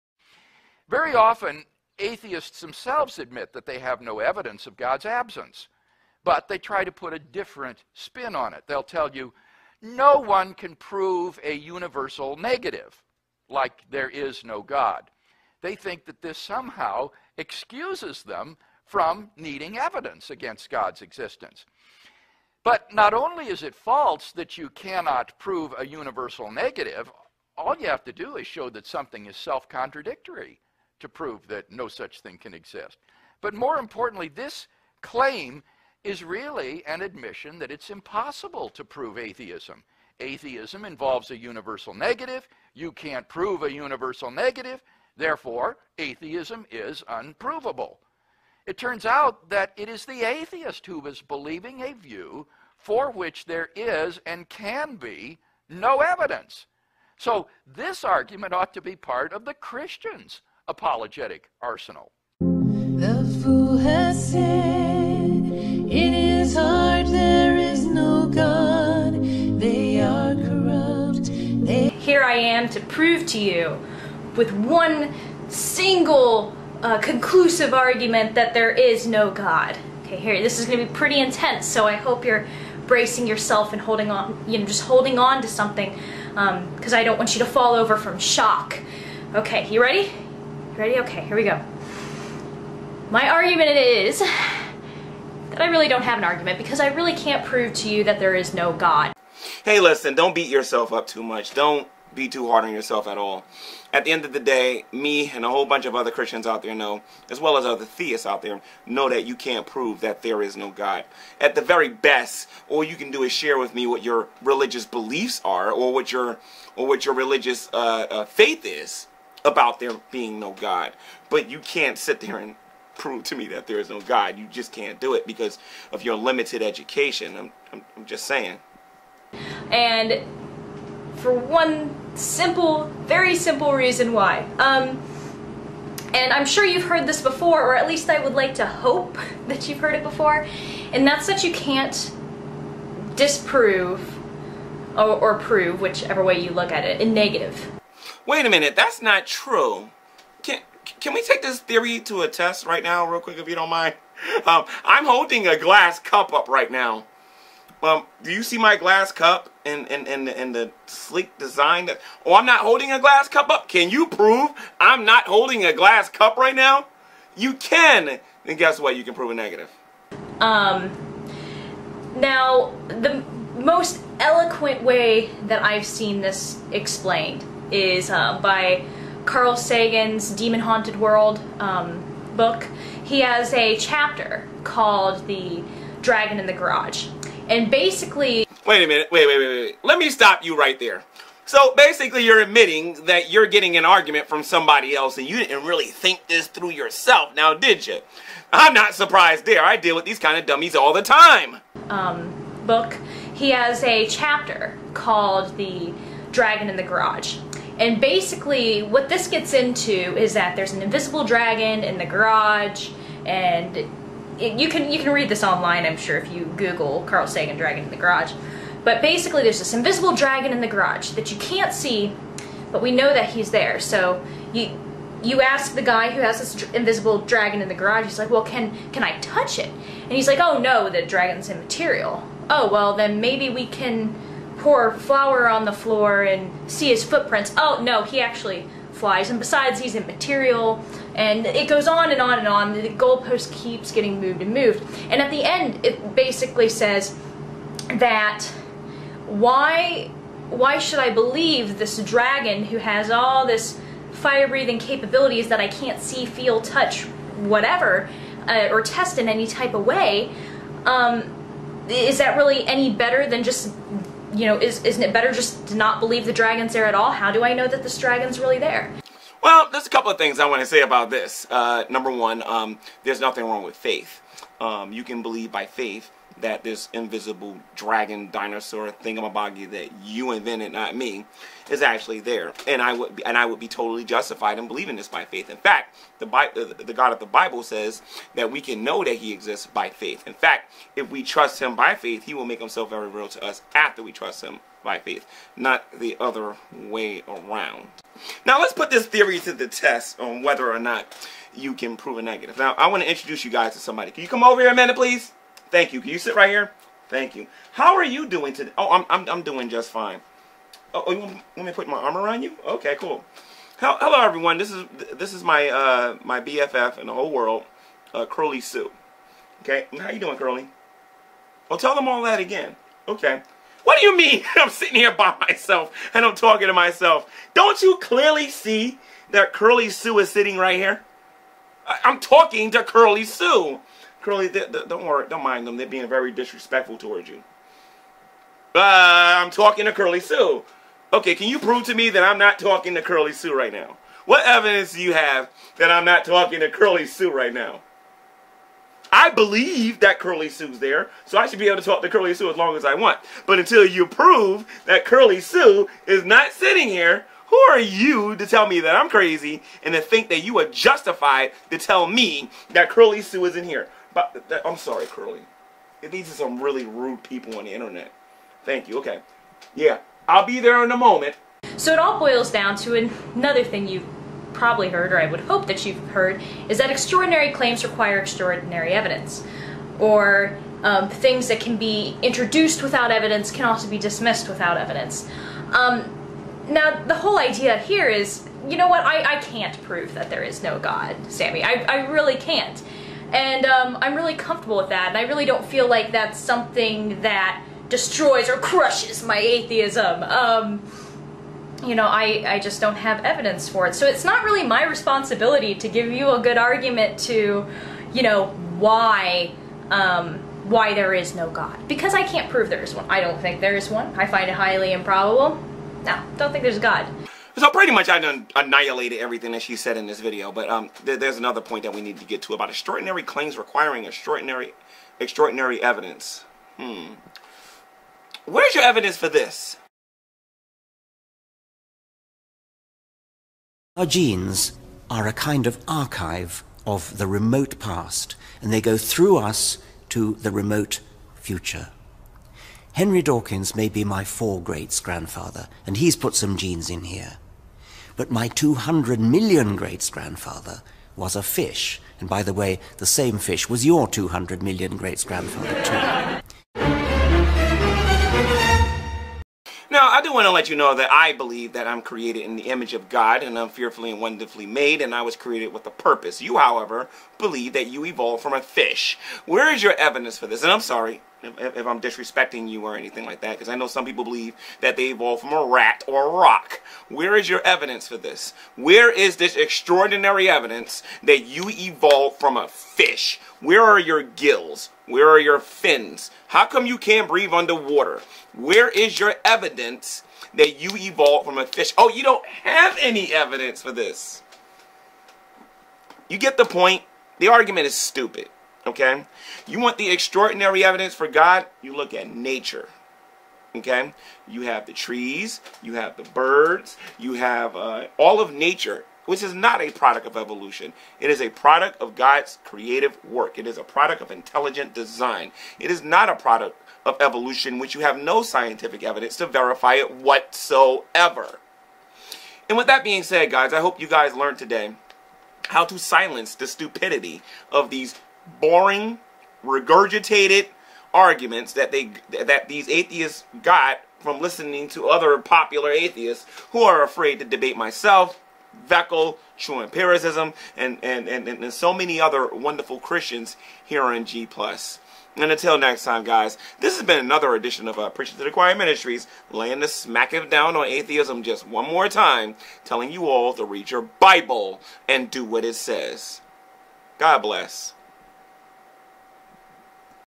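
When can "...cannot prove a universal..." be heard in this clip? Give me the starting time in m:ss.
0:24.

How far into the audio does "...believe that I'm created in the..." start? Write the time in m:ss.
7:41.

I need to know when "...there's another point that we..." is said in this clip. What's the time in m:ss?
7:01.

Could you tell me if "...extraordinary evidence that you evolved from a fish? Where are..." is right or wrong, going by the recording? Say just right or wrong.
right.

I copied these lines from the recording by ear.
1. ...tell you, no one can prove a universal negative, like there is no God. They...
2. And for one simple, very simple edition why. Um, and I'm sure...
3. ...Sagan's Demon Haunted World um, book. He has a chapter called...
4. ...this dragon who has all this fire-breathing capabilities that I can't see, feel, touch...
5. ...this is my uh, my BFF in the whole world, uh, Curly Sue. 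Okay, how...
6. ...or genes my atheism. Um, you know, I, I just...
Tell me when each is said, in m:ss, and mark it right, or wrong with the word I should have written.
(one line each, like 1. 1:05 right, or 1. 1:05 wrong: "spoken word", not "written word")
1. 0:08 right
2. 2:09 wrong: "reason", not "edition"
3. 2:59 right
4. 4:11 right
5. 5:15 right
6. 6:38 wrong: "crushes", not "genes".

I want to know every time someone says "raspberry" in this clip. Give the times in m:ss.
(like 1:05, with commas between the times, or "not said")
not said.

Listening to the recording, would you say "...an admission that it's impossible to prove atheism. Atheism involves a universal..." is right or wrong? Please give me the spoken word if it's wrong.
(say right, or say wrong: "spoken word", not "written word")
right.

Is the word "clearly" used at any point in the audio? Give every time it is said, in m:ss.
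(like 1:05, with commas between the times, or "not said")
5:27.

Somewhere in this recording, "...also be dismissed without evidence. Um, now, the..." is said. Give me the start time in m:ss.
6:23.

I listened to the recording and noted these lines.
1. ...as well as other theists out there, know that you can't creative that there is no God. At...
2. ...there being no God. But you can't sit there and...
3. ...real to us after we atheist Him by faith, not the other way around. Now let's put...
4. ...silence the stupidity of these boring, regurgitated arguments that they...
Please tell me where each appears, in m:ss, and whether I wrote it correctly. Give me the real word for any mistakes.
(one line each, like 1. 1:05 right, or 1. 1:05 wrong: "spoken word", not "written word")
1. 1:47 wrong: "prove", not "creative"
2. 1:59 right
3. 4:53 wrong: "trust", not "atheist"
4. 8:45 right.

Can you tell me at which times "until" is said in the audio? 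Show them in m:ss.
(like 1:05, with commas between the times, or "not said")
5:53, 9:05.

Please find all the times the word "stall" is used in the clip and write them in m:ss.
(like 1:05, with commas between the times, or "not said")
not said.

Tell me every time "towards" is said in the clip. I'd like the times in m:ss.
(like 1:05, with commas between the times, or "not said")
5:36.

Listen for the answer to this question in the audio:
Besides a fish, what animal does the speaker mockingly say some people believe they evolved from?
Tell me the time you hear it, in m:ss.
7:55.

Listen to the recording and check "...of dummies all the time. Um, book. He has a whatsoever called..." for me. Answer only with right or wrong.
wrong.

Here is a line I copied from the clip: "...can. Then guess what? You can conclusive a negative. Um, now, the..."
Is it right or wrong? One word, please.
wrong.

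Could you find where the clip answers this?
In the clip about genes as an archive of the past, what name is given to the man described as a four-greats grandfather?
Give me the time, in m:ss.
7:22.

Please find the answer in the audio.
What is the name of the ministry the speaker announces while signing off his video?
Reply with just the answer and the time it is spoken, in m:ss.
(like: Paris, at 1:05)
Preaching to the Choir Ministries, at 9:08.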